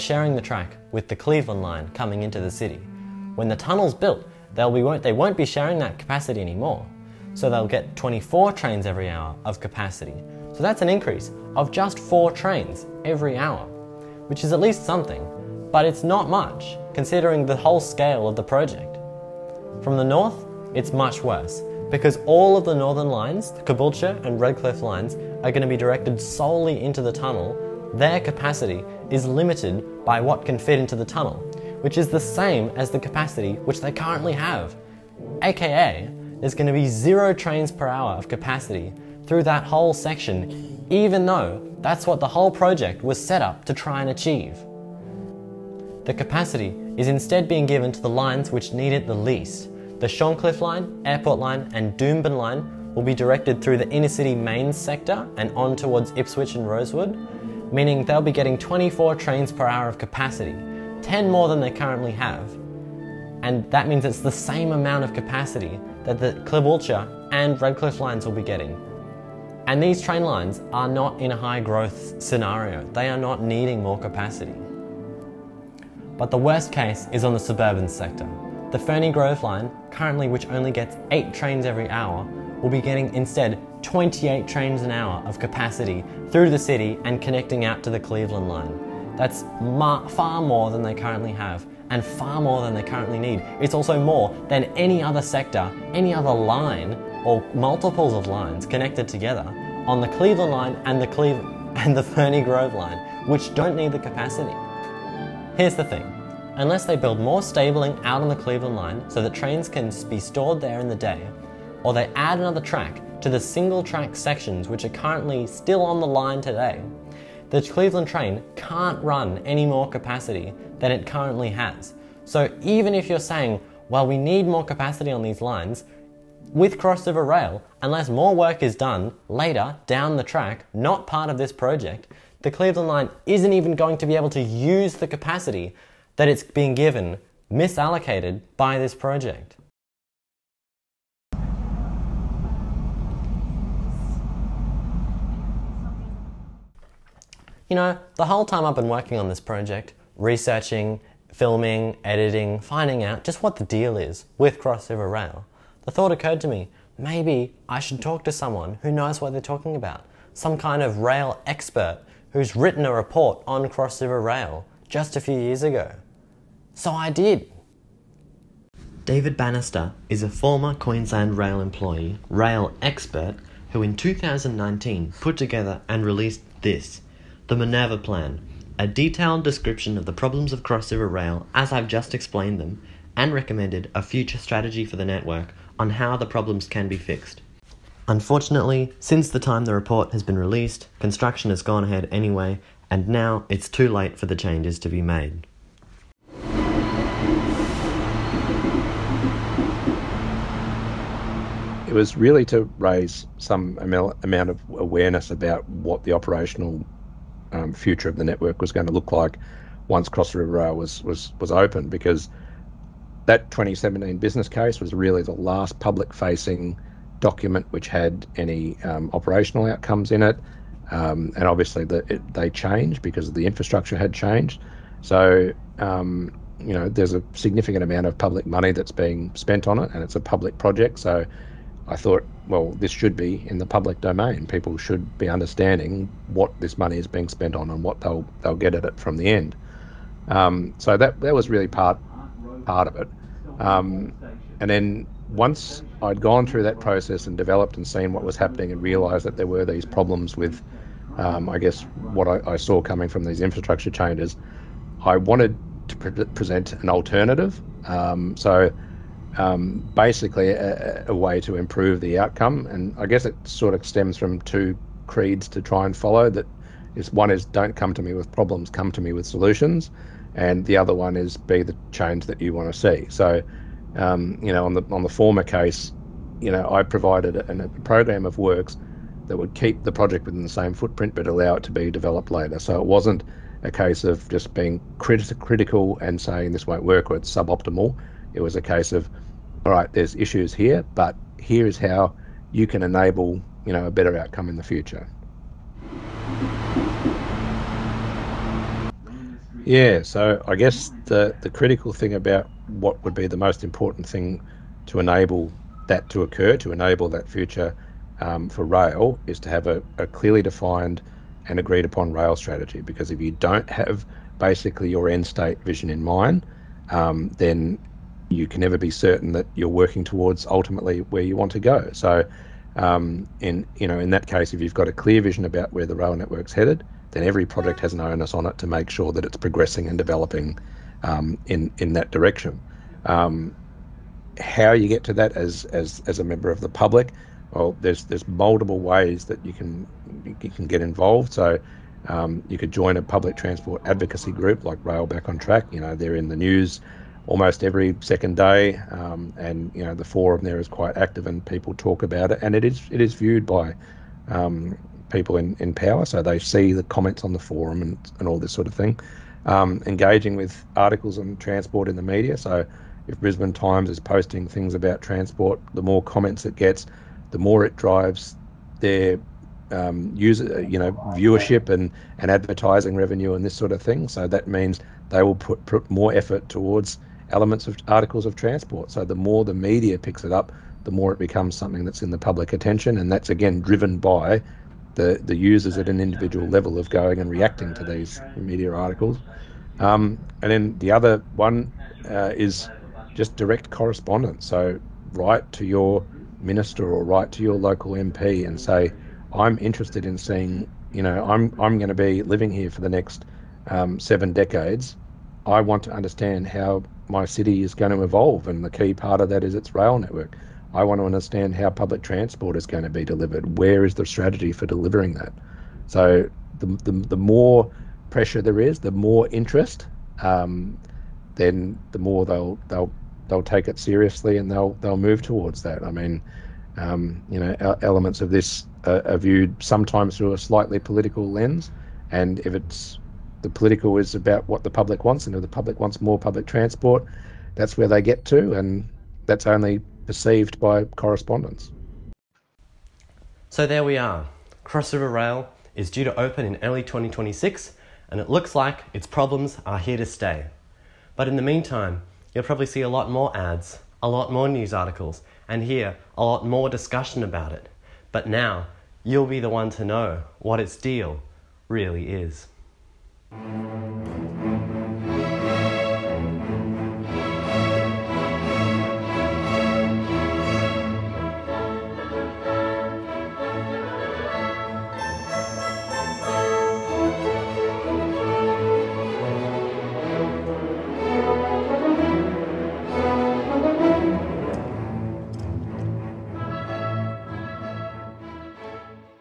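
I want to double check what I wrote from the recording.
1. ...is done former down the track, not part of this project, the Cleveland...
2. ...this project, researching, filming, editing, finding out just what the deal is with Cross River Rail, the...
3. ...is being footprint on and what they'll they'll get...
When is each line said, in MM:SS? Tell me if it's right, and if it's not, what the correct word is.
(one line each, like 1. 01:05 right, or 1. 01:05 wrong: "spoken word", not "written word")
1. 02:08 wrong: "later", not "former"
2. 02:29 right
3. 03:56 wrong: "spent", not "footprint".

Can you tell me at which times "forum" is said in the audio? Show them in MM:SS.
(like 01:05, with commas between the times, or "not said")
05:50, 05:57.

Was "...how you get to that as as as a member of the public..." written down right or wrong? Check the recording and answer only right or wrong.
right.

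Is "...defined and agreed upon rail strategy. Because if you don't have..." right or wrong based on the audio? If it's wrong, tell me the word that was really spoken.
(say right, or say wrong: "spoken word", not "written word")
right.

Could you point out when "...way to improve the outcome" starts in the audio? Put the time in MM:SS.
04:21.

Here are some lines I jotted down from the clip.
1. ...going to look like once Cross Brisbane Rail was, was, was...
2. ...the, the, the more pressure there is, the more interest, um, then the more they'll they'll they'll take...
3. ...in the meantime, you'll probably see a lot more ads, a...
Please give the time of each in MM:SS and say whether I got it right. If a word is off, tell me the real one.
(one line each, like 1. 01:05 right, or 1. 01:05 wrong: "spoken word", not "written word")
1. 03:28 wrong: "River", not "Brisbane"
2. 06:56 right
3. 07:31 right.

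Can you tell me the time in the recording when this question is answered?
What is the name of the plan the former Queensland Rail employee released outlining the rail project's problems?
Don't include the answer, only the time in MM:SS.
02:57.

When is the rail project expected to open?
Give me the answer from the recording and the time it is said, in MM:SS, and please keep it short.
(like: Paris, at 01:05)
early 2026, at 07:26.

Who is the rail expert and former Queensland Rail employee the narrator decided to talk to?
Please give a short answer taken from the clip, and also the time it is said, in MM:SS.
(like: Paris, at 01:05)
David Bannister, at 02:49.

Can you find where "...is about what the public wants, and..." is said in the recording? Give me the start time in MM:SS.
07:13.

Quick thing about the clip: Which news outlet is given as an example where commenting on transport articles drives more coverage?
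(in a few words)
Brisbane Times.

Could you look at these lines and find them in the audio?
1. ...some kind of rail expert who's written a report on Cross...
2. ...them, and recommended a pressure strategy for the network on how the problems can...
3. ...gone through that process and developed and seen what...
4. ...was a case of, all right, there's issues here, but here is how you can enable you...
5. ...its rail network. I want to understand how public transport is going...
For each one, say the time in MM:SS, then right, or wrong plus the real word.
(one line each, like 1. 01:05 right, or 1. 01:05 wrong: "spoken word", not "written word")
1. 02:40 right
2. 03:02 wrong: "future", not "pressure"
3. 04:06 right
4. 04:48 right
5. 06:49 right.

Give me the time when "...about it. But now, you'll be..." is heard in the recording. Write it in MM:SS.
07:37.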